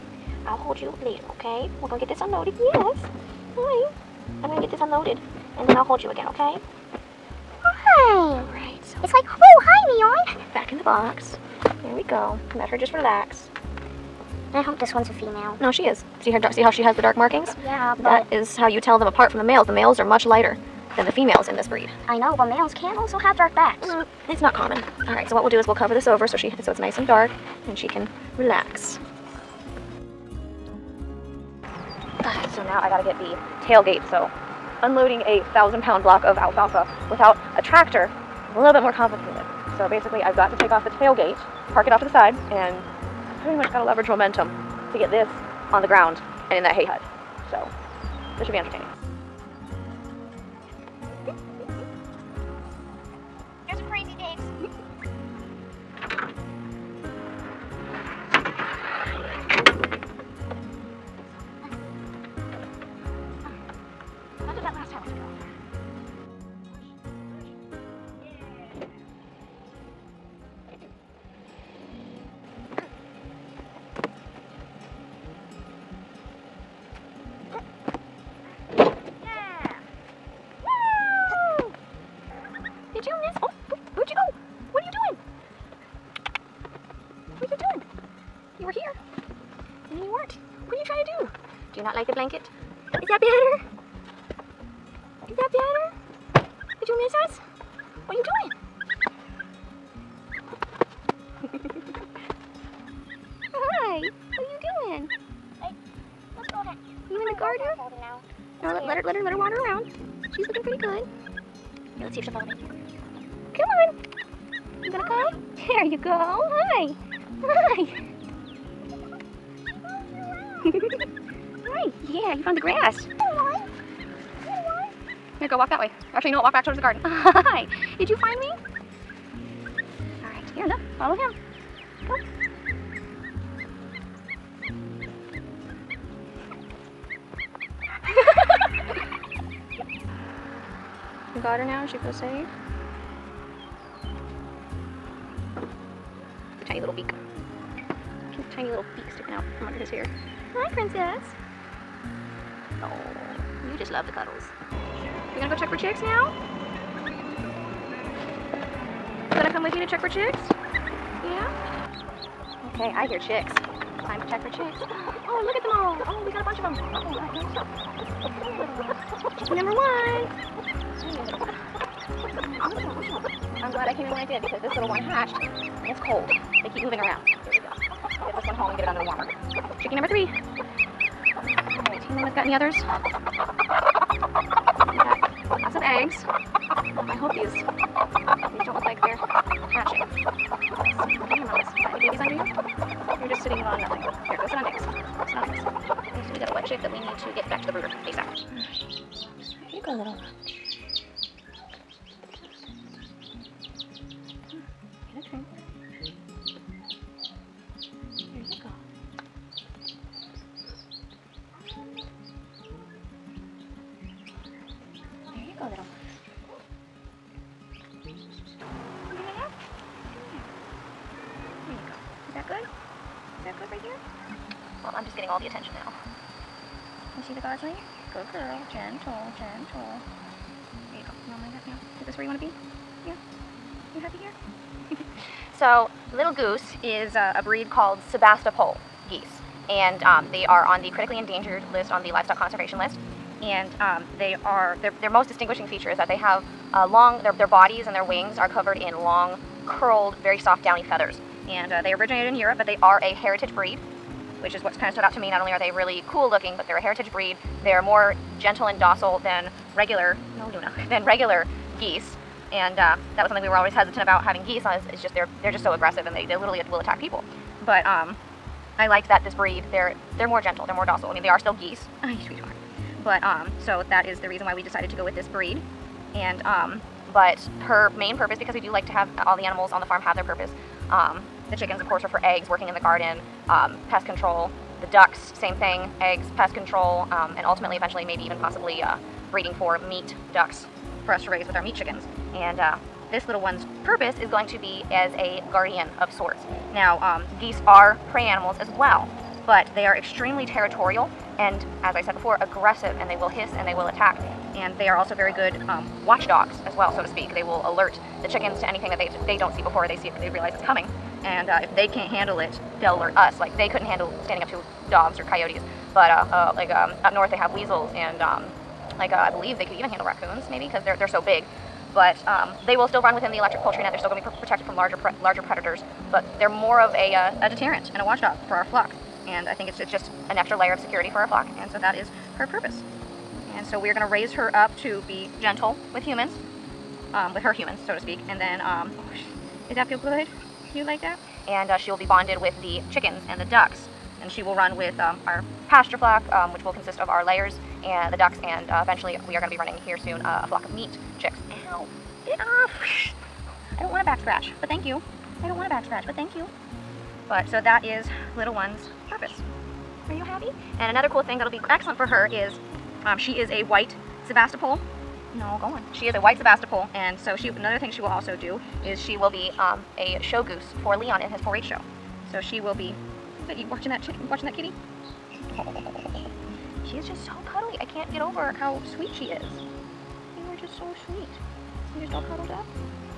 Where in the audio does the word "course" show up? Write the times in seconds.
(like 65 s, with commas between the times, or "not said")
281 s.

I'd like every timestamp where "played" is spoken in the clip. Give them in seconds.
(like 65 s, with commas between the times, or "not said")
not said.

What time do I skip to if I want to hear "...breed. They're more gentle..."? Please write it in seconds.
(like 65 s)
257 s.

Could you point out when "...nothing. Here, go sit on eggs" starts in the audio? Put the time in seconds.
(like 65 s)
193 s.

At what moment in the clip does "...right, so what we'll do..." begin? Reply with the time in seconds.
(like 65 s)
25 s.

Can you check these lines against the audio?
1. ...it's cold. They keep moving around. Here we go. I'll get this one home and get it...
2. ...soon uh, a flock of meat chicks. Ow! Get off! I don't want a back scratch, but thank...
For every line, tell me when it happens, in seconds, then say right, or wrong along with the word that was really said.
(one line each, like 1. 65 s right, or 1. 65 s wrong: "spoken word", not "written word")
1. 175 s right
2. 349 s right.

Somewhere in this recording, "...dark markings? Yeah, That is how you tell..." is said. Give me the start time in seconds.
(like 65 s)
17 s.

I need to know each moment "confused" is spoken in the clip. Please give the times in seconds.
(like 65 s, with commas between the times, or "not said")
not said.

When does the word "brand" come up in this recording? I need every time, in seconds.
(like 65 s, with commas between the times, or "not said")
not said.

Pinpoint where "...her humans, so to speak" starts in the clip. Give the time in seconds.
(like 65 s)
337 s.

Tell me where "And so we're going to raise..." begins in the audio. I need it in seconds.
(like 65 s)
333 s.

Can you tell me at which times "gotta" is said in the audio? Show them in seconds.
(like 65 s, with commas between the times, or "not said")
32 s.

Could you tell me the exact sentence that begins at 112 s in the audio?
Let's see if she'll follow me.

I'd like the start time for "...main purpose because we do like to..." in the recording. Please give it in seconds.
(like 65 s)
277 s.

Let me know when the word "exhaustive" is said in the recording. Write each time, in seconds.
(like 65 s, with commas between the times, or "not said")
not said.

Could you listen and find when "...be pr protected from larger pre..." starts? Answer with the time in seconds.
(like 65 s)
324 s.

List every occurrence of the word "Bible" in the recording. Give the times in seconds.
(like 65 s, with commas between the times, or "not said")
not said.